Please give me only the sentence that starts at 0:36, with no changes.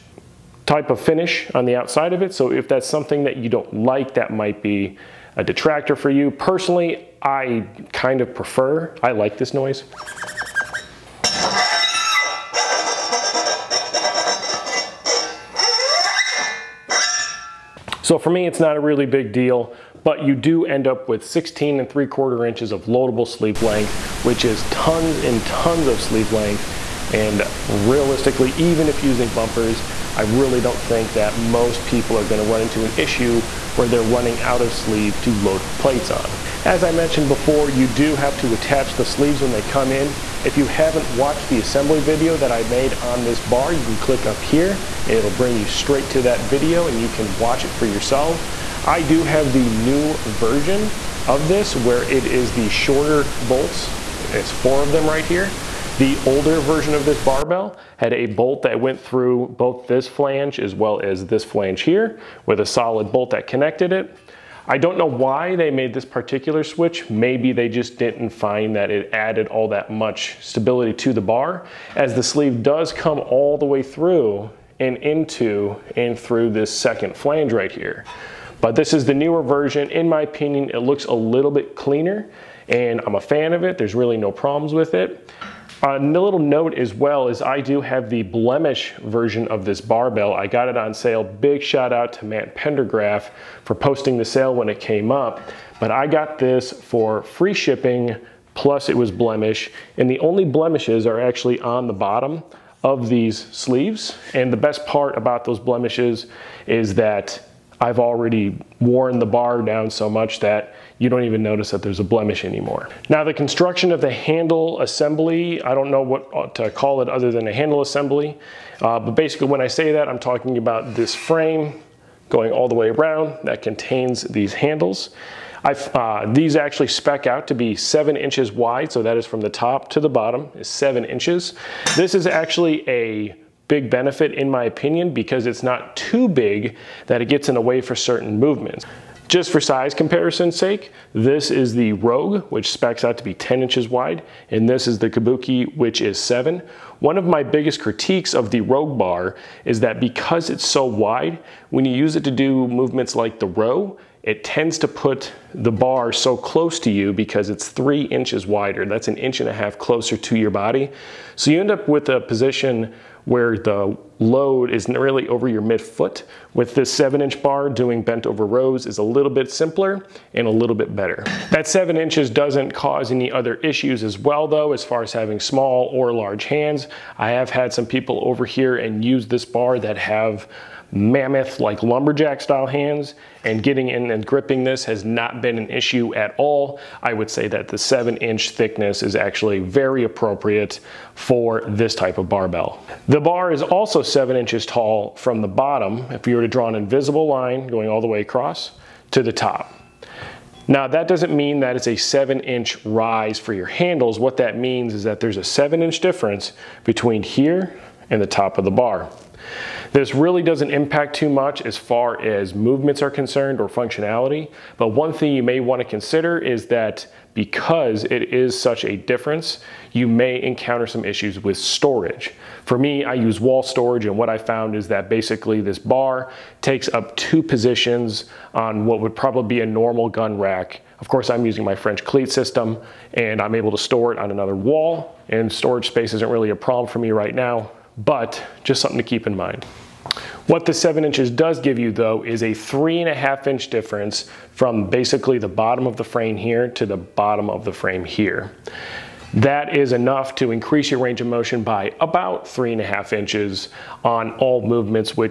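As I mentioned before, you do have to attach the sleeves when they come in.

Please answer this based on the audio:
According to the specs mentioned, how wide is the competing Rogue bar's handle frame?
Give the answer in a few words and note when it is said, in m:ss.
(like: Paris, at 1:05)
10 inches, at 2:23.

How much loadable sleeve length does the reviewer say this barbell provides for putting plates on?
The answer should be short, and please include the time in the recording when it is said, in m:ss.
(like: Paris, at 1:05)
16 3/4 inches, at 0:21.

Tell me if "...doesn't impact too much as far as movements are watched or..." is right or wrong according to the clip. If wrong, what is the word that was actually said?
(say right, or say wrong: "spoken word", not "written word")
wrong: "concerned", not "watched".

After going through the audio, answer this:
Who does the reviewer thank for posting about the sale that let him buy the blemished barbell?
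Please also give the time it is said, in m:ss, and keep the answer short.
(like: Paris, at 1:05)
Matt Pendergraph, at 1:32.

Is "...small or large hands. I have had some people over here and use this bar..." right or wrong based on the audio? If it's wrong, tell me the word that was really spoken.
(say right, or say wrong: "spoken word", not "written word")
right.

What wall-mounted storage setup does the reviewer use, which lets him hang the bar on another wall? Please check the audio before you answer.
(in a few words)
French cleat system.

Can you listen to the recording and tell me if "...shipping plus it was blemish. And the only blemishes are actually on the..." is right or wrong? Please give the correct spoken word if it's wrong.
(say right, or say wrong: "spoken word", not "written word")
right.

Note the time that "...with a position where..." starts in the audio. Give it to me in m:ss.
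2:41.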